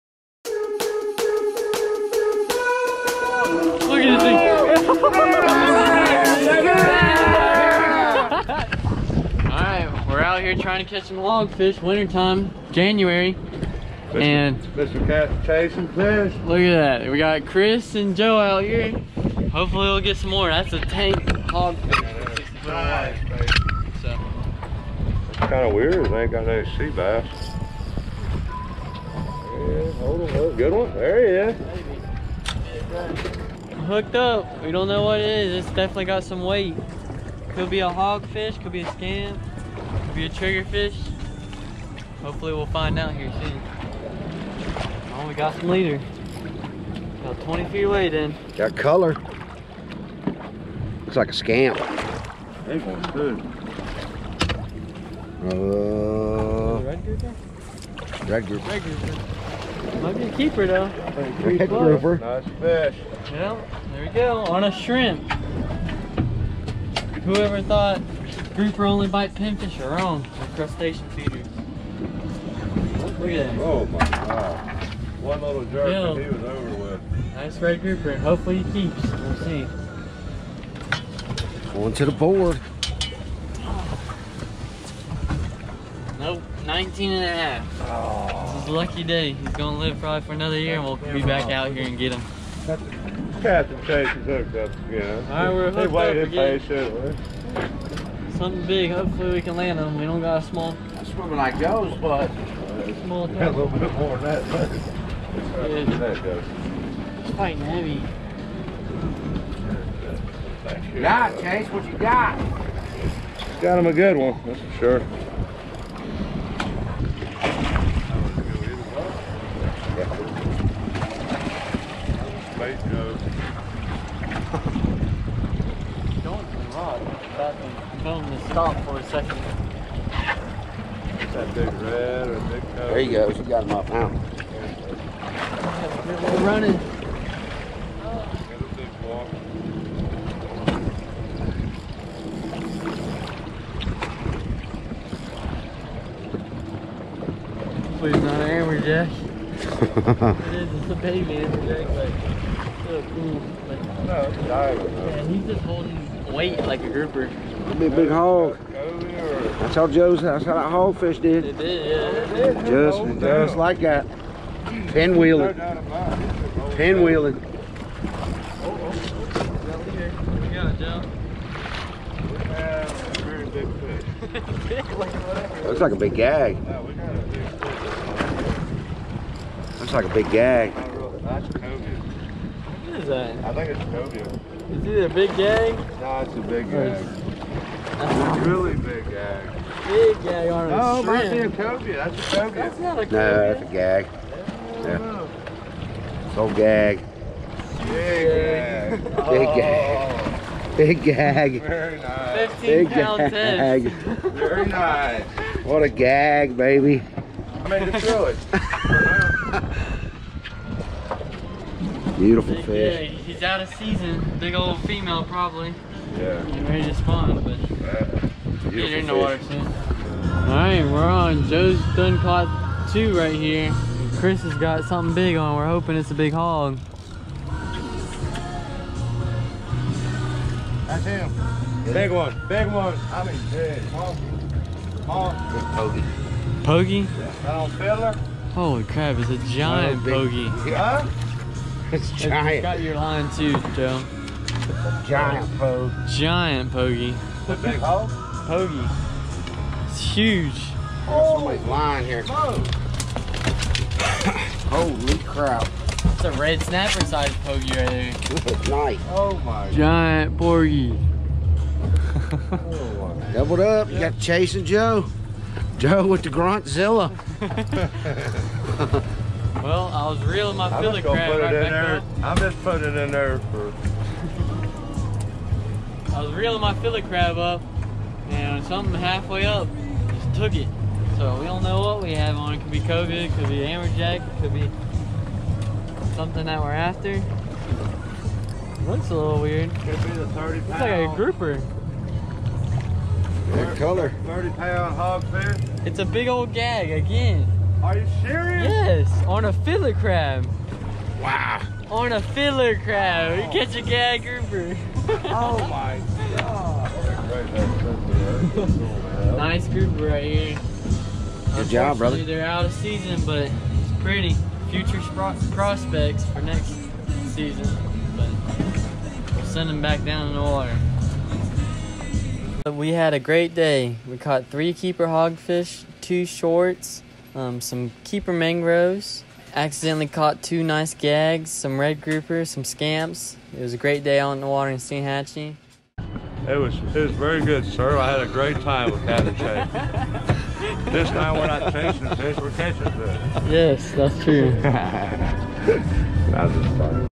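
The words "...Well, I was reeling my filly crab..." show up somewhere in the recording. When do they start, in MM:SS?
04:29.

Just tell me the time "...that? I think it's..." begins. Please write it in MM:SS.
03:03.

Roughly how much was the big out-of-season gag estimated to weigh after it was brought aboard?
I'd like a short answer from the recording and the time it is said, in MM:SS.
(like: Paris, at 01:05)
15 pound, at 03:22.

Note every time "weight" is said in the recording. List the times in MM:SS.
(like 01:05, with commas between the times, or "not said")
00:36, 02:36.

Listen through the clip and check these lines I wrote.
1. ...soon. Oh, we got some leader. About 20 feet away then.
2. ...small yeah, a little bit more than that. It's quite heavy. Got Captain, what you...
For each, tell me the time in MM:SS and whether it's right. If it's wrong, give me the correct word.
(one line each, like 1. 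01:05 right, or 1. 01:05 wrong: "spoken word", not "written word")
1. 00:43 right
2. 01:43 wrong: "Chase", not "Captain".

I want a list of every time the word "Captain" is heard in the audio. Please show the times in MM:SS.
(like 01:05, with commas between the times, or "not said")
01:33, 05:39.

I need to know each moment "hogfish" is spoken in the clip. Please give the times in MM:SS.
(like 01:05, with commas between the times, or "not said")
00:11, 00:21, 00:37, 04:54, 05:25.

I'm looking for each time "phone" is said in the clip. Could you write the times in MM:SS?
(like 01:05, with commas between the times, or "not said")
02:08.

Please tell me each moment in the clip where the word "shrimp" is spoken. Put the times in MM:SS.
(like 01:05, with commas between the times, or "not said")
01:04, 03:11.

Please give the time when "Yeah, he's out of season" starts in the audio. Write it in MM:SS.
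03:33.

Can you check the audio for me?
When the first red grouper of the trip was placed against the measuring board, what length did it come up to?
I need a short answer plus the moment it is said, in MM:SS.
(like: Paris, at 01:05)
19 and a half, at 01:26.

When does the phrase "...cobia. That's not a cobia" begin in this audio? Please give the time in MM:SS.
03:12.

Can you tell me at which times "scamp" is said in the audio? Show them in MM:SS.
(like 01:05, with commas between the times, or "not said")
00:38, 00:51, 05:32.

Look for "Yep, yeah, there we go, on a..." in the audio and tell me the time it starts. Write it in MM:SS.
01:02.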